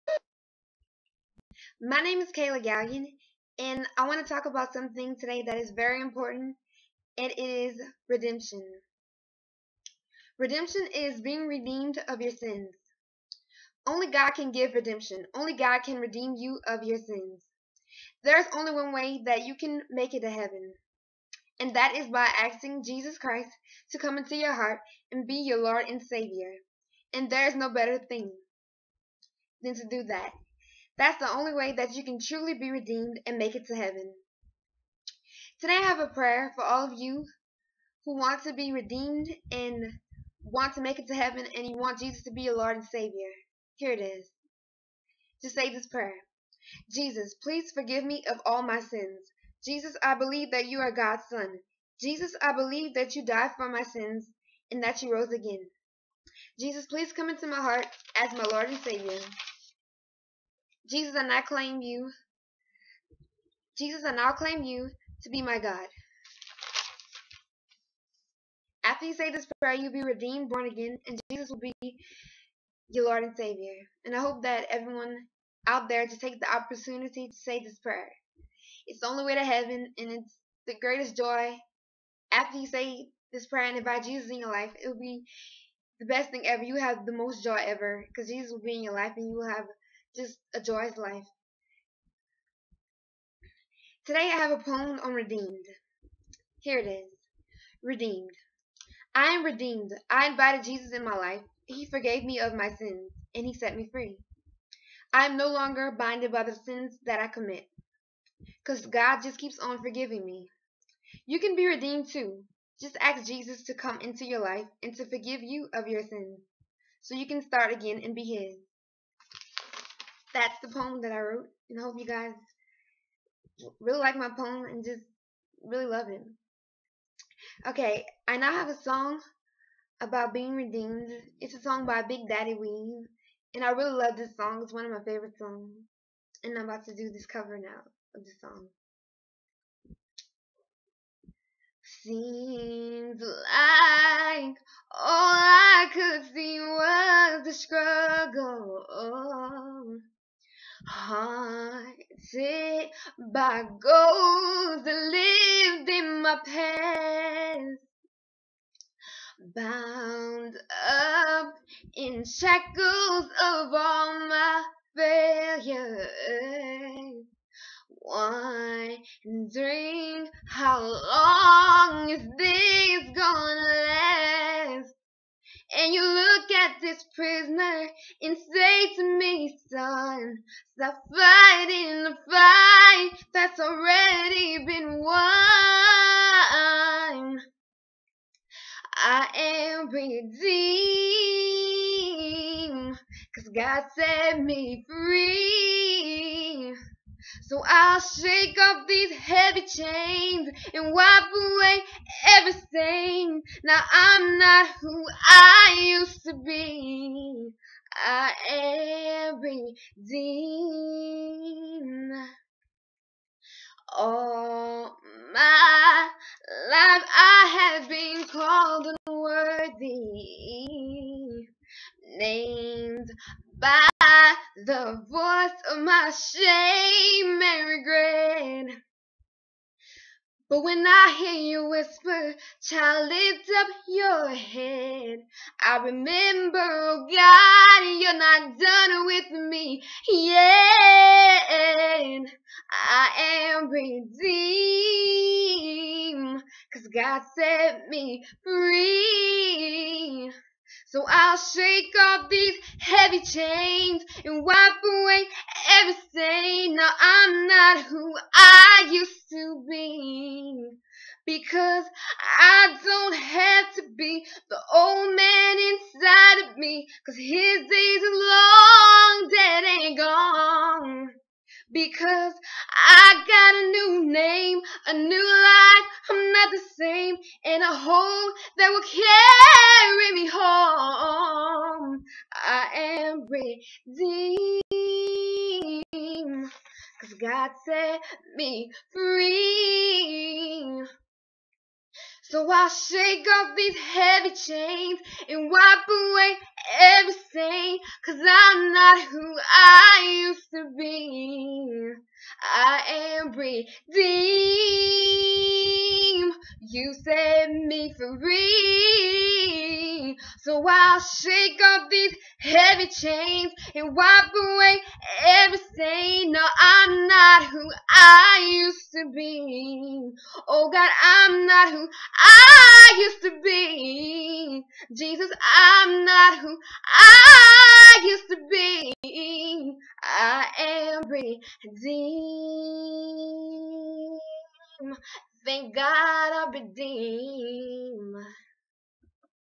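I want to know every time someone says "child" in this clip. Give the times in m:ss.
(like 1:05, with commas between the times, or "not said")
3:52.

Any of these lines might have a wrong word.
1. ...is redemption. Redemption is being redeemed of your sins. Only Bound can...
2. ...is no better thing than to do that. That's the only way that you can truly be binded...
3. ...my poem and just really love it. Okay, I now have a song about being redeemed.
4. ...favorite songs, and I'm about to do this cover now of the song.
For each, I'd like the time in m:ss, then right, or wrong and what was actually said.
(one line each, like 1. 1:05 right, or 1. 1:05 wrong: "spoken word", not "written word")
1. 0:07 wrong: "God", not "Bound"
2. 0:27 wrong: "redeemed", not "binded"
3. 2:04 right
4. 2:15 right.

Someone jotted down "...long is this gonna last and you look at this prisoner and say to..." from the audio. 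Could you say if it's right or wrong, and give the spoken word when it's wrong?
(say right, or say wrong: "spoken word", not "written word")
right.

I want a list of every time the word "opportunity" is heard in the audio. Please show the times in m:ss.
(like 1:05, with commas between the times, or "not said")
1:16.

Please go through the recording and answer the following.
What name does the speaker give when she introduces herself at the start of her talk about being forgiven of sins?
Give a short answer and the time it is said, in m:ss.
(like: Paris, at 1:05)
Kayla Gallien, at 0:02.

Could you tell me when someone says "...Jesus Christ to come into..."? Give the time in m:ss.
0:22.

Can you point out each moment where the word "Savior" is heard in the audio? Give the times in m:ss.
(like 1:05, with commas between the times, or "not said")
0:26, 0:42, 0:58, 1:13.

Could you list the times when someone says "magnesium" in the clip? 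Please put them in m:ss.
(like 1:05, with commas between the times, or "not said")
not said.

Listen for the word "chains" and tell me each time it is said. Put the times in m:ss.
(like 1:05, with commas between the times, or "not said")
3:19, 4:13, 4:54, 5:12.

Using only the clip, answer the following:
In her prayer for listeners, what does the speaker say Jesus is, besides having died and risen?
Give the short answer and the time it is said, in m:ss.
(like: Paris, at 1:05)
God's Son, at 0:50.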